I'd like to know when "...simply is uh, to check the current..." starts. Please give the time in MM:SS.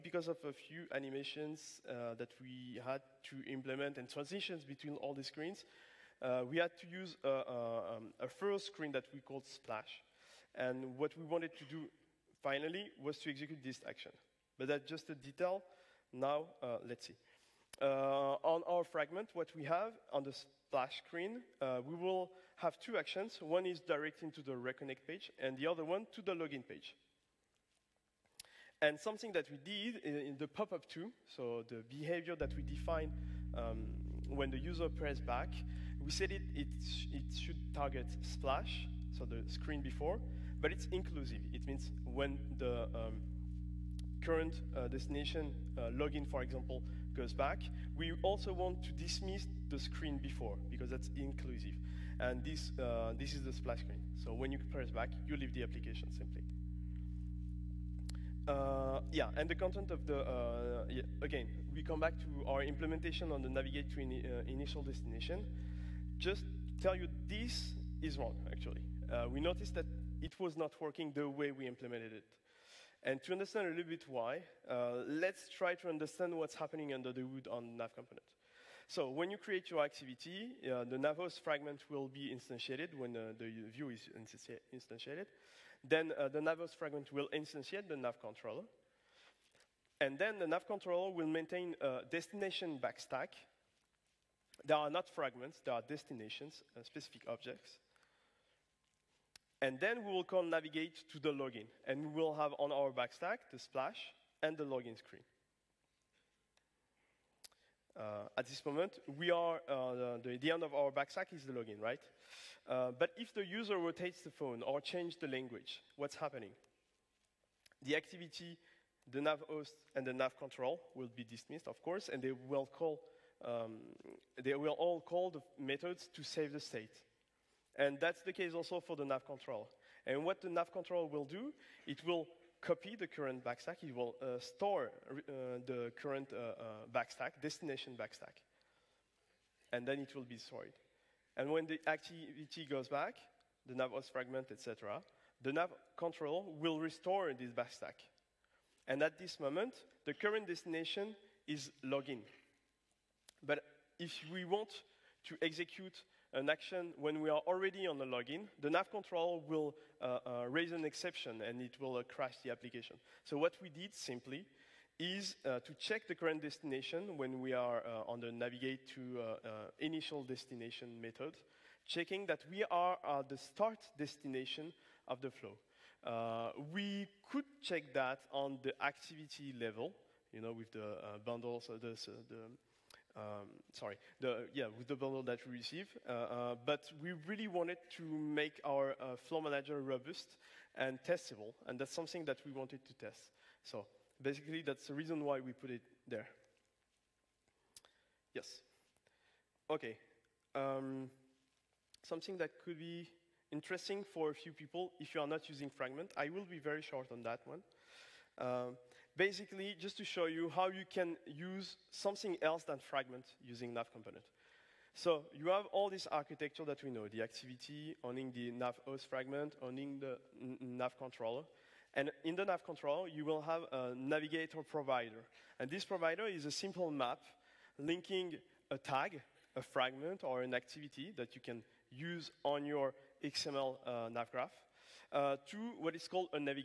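02:43.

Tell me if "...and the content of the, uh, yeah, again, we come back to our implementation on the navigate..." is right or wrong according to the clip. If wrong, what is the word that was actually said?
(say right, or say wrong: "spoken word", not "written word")
right.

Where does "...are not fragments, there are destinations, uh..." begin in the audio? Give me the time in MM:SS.
01:34.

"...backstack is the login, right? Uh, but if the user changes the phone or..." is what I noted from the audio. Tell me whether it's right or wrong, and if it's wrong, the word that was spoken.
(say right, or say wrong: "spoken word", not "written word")
wrong: "rotates", not "changes".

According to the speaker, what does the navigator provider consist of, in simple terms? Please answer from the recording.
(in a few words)
A simple map.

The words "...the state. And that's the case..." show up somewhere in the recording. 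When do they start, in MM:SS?
02:06.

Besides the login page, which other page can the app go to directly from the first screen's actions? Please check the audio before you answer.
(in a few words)
Reconnect page.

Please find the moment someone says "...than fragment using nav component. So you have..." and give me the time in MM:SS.
03:32.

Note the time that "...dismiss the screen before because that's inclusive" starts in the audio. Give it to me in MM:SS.
00:48.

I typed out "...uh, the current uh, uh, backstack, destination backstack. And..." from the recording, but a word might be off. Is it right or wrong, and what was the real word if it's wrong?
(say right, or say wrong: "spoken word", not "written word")
right.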